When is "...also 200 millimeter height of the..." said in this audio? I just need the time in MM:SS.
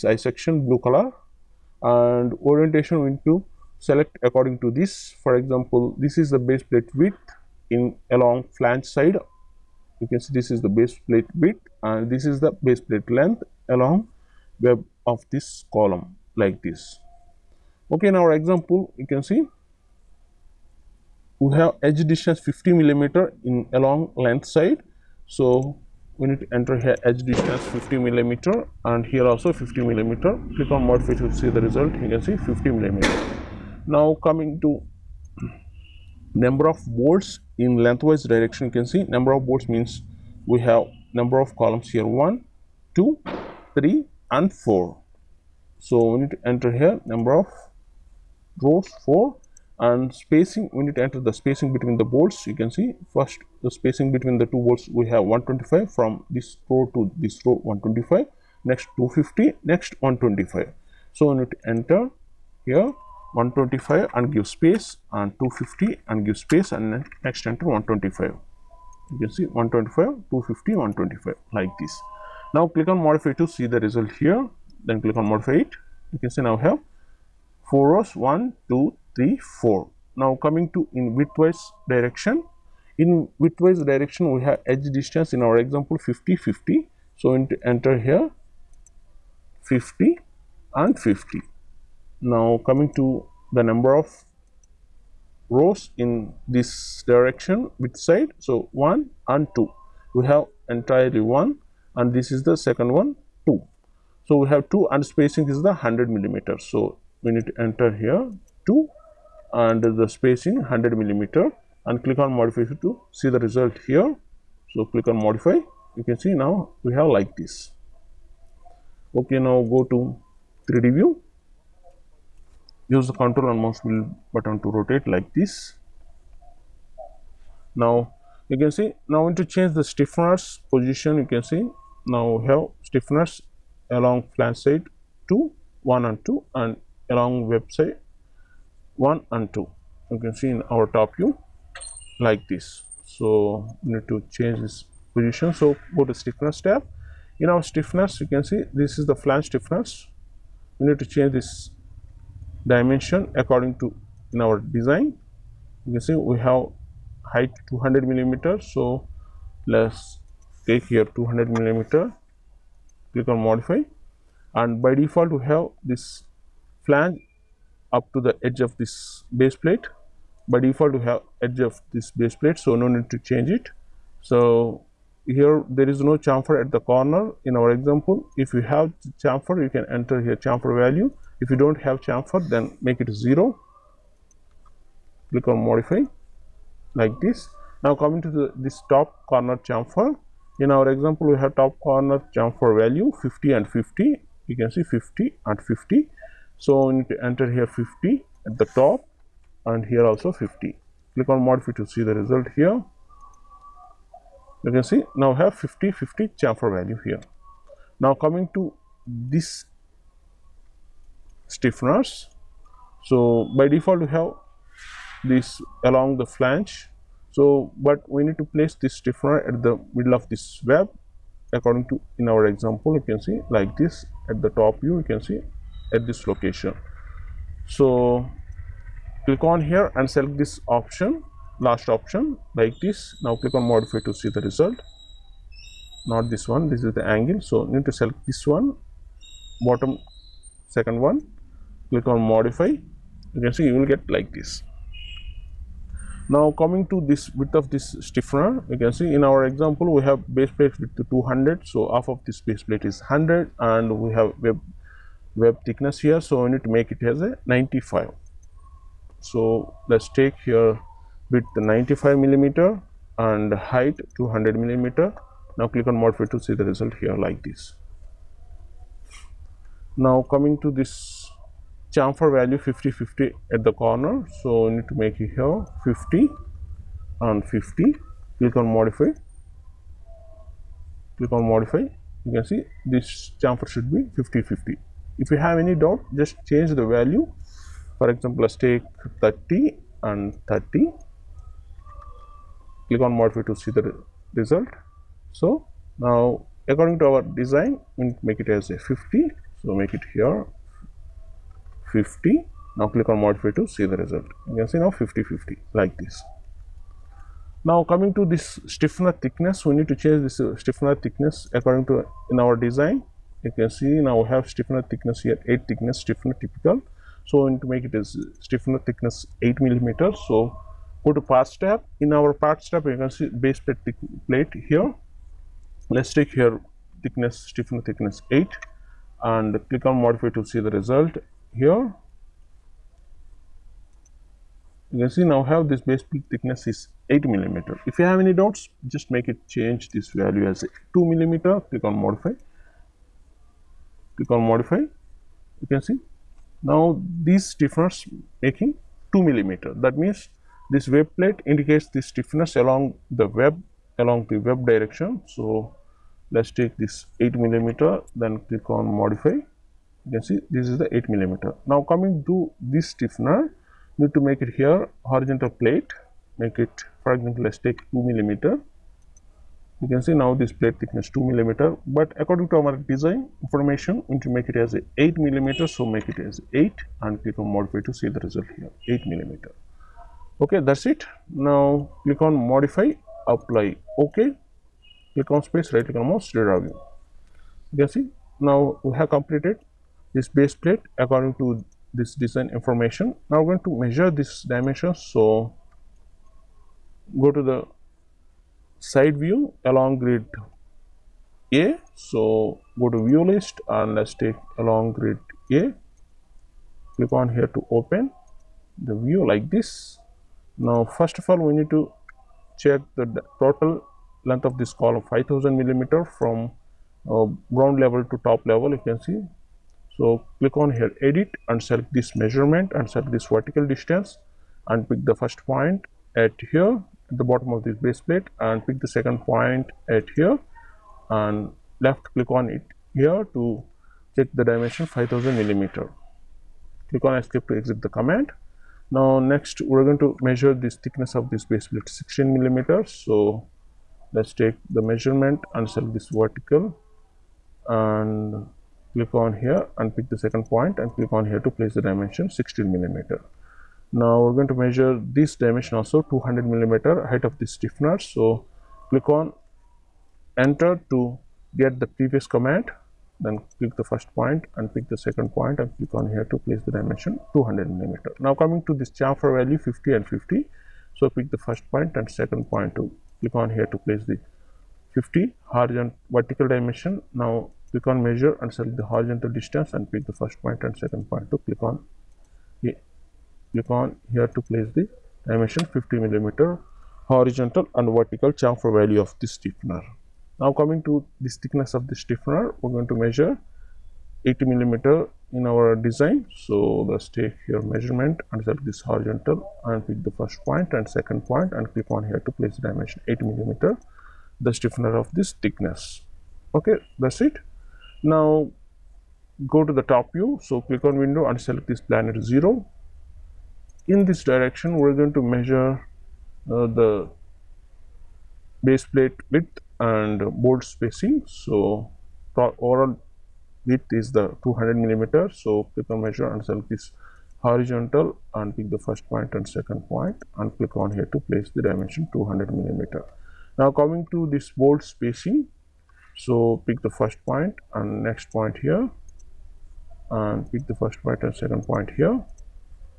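07:35.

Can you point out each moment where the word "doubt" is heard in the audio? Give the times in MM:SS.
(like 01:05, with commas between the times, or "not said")
04:45, 05:38.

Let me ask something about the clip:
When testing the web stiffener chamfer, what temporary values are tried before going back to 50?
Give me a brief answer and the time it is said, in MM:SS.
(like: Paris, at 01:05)
30 and 30, at 04:49.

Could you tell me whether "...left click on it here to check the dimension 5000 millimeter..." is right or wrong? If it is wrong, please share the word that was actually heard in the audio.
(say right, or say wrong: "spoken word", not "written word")
right.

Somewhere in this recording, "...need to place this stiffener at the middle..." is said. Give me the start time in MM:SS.
03:38.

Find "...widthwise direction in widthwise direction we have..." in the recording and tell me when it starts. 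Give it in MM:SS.
01:21.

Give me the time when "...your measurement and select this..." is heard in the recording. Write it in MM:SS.
08:17.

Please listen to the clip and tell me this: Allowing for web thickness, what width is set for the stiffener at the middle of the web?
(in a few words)
95 millimeter.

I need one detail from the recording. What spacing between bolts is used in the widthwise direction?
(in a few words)
100 millimeters.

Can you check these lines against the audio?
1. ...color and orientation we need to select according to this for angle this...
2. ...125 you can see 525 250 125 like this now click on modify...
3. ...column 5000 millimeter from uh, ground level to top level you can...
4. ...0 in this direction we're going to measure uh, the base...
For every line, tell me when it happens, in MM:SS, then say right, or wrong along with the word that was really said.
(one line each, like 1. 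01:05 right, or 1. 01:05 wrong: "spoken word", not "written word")
1. 00:00 wrong: "example", not "angle"
2. 01:07 wrong: "125", not "525"
3. 06:54 right
4. 08:32 right.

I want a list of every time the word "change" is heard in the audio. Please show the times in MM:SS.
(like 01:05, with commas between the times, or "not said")
02:09, 02:24, 02:31, 02:53, 04:46, 05:10, 05:39.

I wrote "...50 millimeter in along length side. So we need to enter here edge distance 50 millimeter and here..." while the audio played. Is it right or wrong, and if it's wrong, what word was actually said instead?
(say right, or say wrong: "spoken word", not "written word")
right.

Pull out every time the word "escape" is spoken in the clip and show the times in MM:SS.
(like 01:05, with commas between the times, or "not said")
07:17.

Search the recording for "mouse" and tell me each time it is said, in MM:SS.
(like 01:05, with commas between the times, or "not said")
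02:03, 06:26.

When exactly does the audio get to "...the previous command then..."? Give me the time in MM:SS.
07:41.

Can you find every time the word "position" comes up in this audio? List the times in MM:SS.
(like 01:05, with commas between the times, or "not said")
02:10, 02:25.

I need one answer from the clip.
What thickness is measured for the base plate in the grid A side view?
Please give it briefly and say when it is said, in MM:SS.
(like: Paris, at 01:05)
16 millimeters, at 07:21.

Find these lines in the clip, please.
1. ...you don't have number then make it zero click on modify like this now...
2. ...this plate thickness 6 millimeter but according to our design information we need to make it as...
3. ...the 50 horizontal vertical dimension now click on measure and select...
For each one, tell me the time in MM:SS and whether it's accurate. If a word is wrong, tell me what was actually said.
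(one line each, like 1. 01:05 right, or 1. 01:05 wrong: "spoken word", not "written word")
1. 03:01 wrong: "chamfer", not "number"
2. 06:10 wrong: "2", not "6"
3. 07:54 right.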